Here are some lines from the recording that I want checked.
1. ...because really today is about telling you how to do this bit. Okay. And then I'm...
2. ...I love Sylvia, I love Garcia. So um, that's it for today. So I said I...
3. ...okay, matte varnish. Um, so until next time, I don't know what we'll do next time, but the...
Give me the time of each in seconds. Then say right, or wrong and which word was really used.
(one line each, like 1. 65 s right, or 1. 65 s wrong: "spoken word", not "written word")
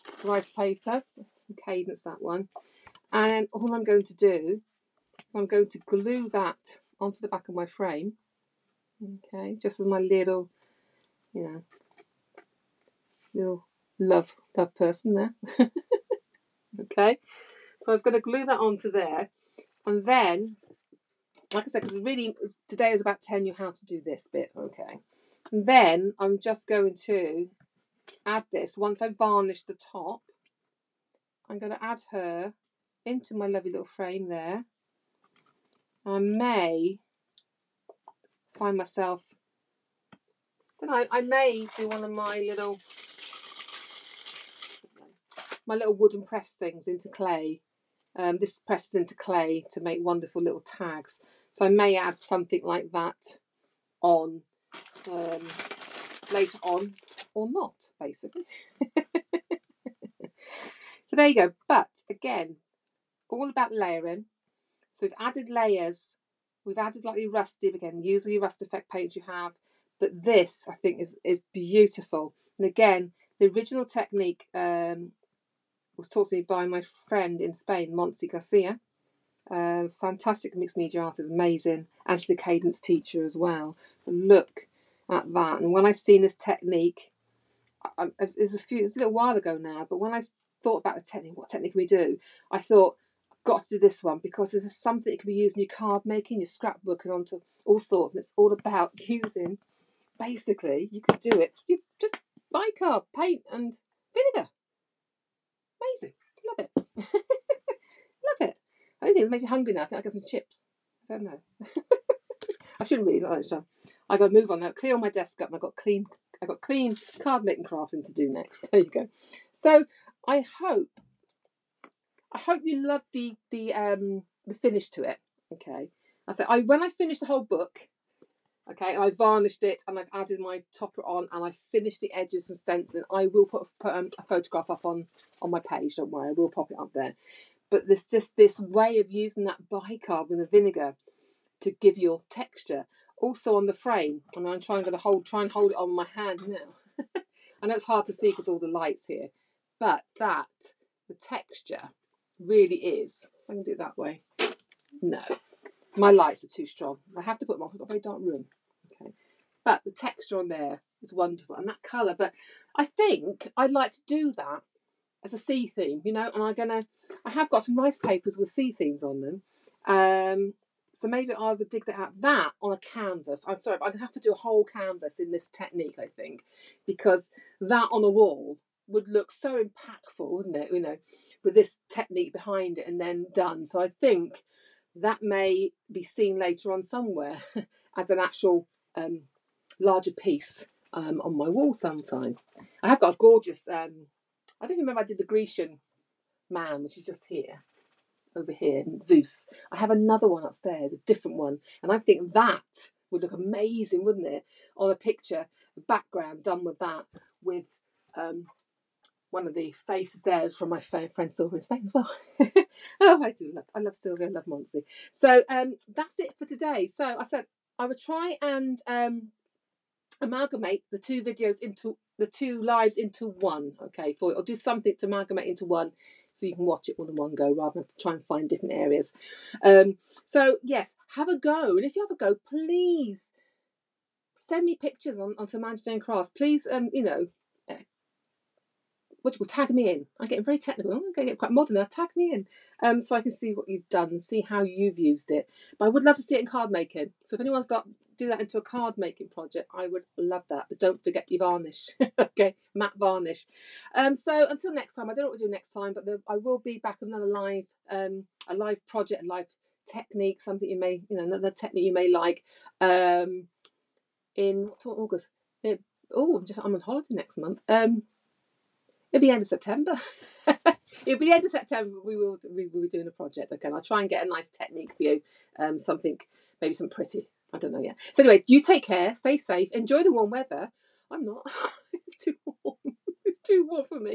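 1. 21 s right
2. 213 s wrong: "Monty", not "Garcia"
3. 252 s right.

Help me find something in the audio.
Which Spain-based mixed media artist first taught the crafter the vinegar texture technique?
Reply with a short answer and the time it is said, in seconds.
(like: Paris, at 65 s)
Montse Garcia, at 77 s.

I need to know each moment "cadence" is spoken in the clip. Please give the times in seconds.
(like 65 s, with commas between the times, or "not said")
1 s, 82 s.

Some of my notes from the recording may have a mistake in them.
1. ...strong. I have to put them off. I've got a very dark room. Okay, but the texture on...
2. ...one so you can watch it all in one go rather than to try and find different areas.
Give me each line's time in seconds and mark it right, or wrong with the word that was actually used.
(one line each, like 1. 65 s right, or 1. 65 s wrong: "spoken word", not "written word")
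1. 156 s right
2. 225 s right.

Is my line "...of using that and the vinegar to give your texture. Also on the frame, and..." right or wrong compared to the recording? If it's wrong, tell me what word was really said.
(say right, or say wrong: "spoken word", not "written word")
right.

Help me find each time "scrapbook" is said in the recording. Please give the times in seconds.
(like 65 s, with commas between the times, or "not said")
96 s.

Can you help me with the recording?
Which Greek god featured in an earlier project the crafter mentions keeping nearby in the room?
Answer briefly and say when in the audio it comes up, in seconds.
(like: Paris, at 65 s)
Zeus, at 199 s.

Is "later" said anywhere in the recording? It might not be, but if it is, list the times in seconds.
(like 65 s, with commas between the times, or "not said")
56 s, 186 s.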